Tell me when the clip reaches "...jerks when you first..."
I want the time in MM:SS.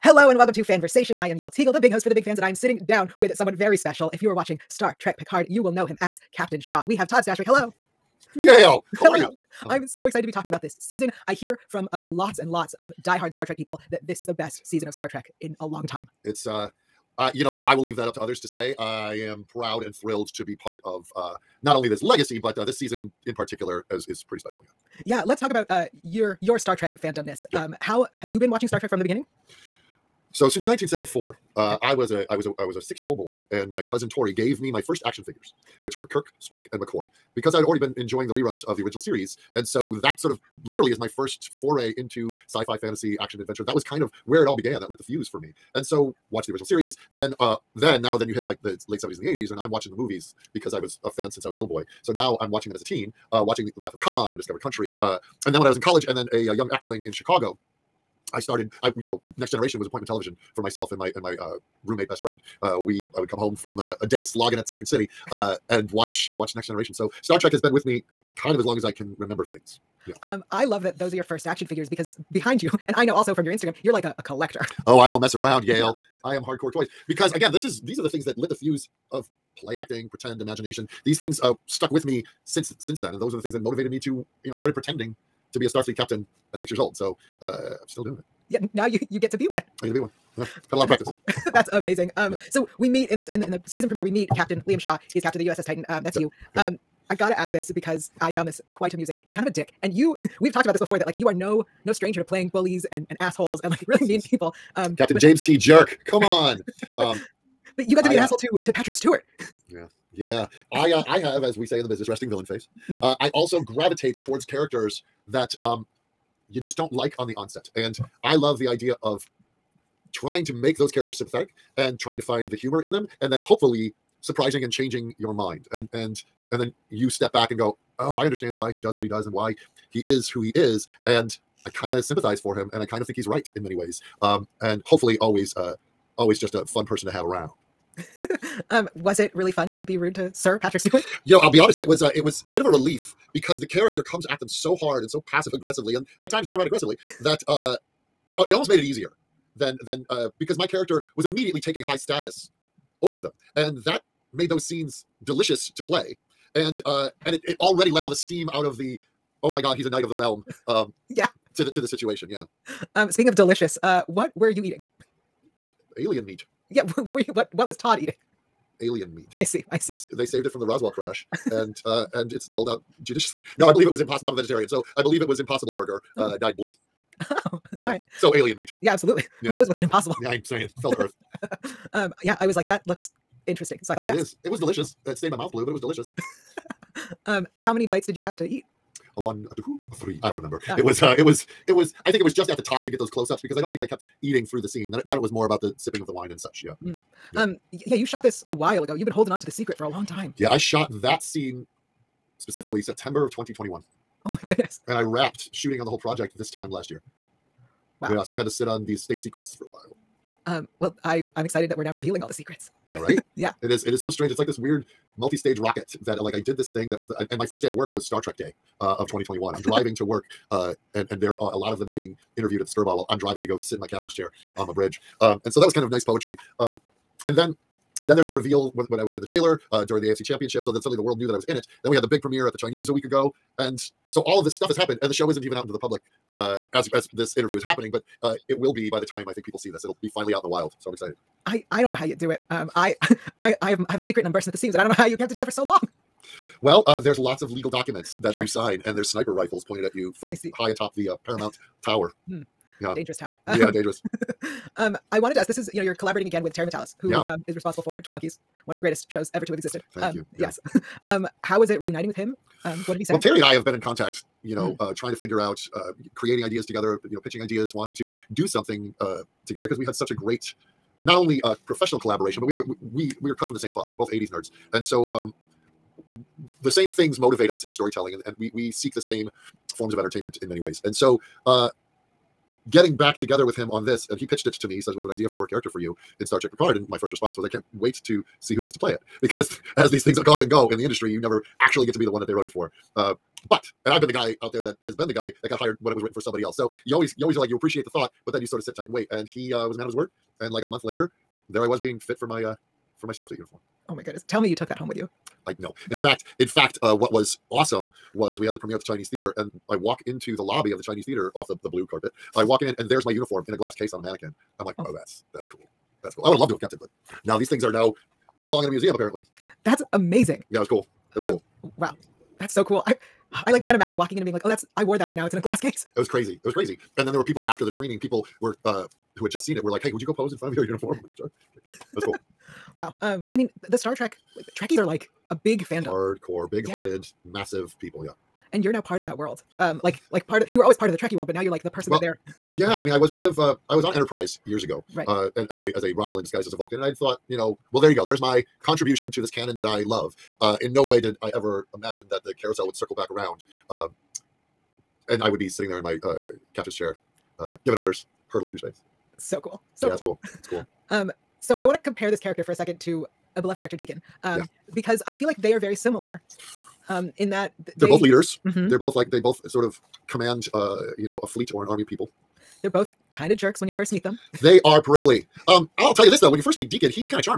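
06:13.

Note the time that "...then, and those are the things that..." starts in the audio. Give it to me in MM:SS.
01:22.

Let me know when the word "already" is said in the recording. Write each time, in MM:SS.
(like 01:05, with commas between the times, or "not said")
00:37, 02:37.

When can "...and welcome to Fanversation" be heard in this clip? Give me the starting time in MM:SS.
00:00.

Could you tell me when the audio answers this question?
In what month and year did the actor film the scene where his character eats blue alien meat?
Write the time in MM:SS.
03:22.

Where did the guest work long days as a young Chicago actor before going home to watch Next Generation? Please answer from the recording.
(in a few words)
Second City.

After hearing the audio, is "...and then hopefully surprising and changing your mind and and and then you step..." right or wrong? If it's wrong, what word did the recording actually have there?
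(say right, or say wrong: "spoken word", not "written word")
right.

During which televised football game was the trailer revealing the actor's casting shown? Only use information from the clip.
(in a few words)
AFC Championship.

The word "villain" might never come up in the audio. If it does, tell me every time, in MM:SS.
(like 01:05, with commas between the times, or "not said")
01:52.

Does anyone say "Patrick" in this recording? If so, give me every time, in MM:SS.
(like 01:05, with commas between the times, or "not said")
01:48, 02:20.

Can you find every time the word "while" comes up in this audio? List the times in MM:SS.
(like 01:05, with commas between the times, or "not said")
03:18, 03:29, 03:42.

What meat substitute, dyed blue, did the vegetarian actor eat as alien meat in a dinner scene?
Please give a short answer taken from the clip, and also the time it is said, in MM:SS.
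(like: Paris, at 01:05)
Impossible burger, at 02:55.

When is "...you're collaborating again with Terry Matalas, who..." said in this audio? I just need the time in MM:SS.
04:15.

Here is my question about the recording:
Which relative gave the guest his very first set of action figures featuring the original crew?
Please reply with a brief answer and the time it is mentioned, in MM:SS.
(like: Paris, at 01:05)
Cousin Tori, at 00:33.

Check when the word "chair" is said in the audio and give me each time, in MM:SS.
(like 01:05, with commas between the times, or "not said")
03:44, 05:56.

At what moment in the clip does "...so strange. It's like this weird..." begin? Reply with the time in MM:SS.
03:34.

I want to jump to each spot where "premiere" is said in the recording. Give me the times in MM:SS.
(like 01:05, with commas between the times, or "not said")
01:33, 03:52, 05:08.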